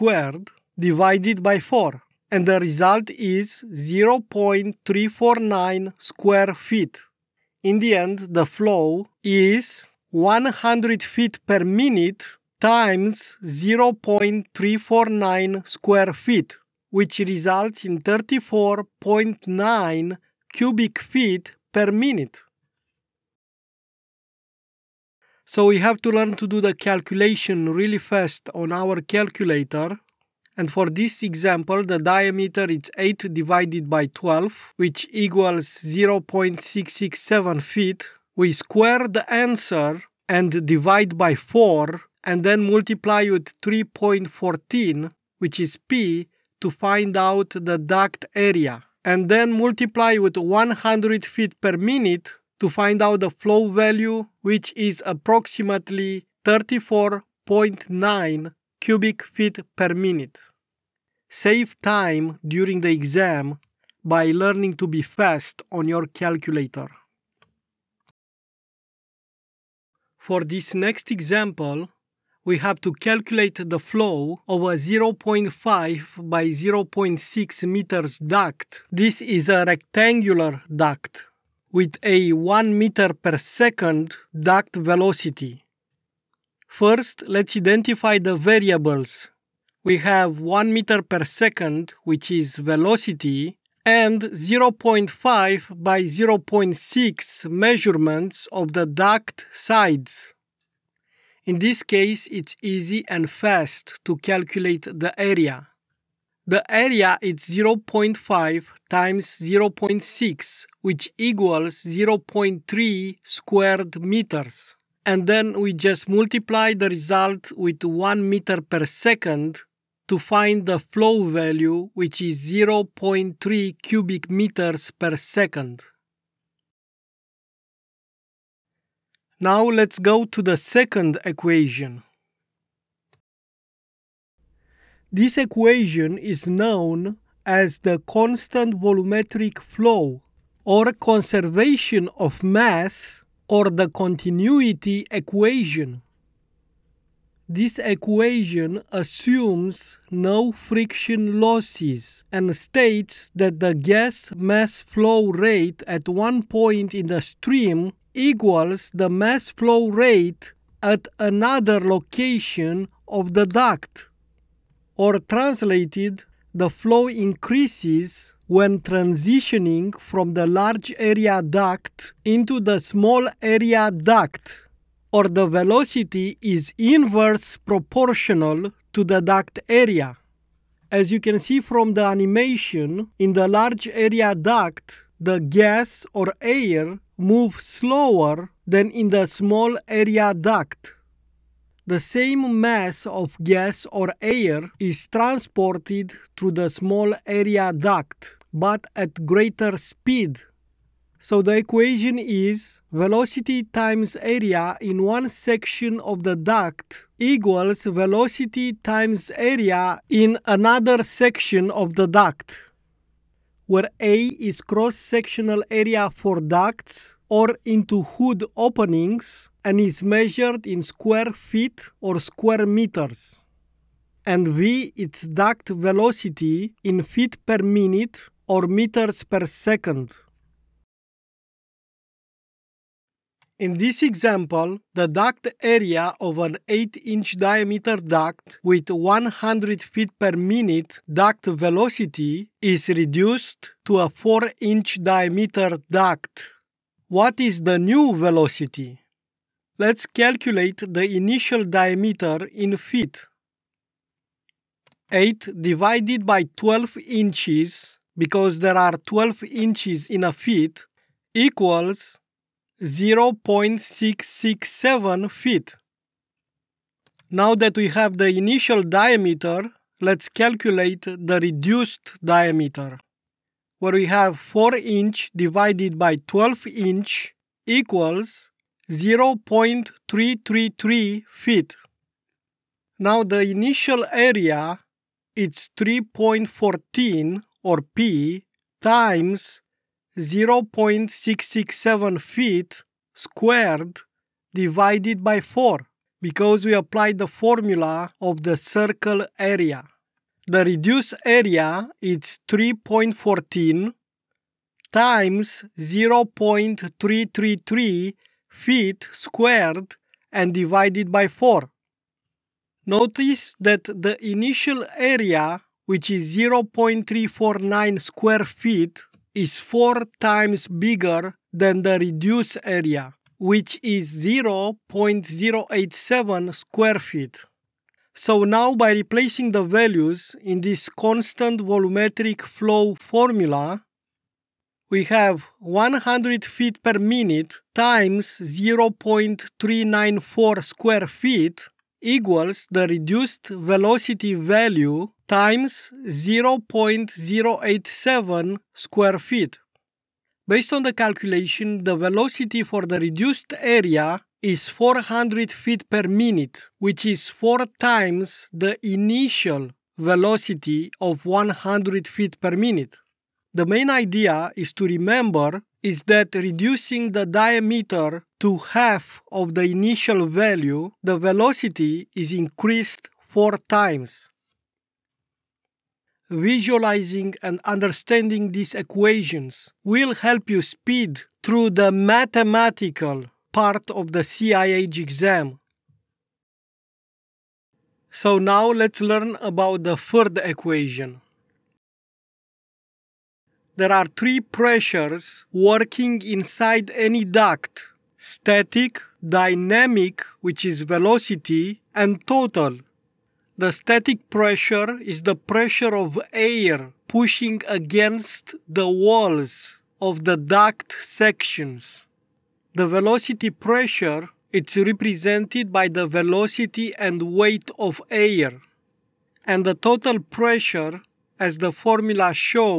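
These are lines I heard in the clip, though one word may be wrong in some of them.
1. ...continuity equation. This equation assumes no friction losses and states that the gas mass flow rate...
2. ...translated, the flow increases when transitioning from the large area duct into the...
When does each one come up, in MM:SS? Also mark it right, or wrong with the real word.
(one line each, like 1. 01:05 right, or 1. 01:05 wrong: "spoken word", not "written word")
1. 02:23 right
2. 02:45 right.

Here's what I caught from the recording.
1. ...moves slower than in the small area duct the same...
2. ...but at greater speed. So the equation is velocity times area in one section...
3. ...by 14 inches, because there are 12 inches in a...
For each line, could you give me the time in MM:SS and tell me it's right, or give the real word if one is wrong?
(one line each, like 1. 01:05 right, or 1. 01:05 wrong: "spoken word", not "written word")
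1. 03:07 right
2. 03:18 right
3. 04:16 wrong: "12", not "14".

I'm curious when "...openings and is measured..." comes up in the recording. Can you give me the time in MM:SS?
03:38.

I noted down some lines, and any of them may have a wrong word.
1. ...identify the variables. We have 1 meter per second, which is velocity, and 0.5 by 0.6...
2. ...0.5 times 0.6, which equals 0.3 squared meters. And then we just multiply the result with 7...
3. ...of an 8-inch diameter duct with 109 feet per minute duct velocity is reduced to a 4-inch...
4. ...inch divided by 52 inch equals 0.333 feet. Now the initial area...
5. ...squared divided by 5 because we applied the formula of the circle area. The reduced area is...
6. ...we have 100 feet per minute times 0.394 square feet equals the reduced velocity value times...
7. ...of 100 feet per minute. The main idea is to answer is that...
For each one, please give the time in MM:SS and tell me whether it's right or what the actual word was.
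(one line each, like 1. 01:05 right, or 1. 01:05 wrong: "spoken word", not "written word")
1. 01:27 right
2. 01:47 wrong: "1", not "7"
3. 03:56 wrong: "100", not "109"
4. 04:34 wrong: "12", not "52"
5. 04:53 wrong: "4", not "5"
6. 05:34 right
7. 06:00 wrong: "remember", not "answer".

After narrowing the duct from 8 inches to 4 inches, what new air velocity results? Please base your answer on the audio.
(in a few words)
400 feet per minute.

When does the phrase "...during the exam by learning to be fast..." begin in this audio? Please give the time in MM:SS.
01:02.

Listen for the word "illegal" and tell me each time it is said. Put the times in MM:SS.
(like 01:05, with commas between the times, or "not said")
not said.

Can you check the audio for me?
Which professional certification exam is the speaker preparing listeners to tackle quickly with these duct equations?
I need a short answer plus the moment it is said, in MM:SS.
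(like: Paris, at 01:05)
CIH exam, at 06:24.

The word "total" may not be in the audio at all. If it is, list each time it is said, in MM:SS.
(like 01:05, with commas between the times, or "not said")
06:42, 06:59.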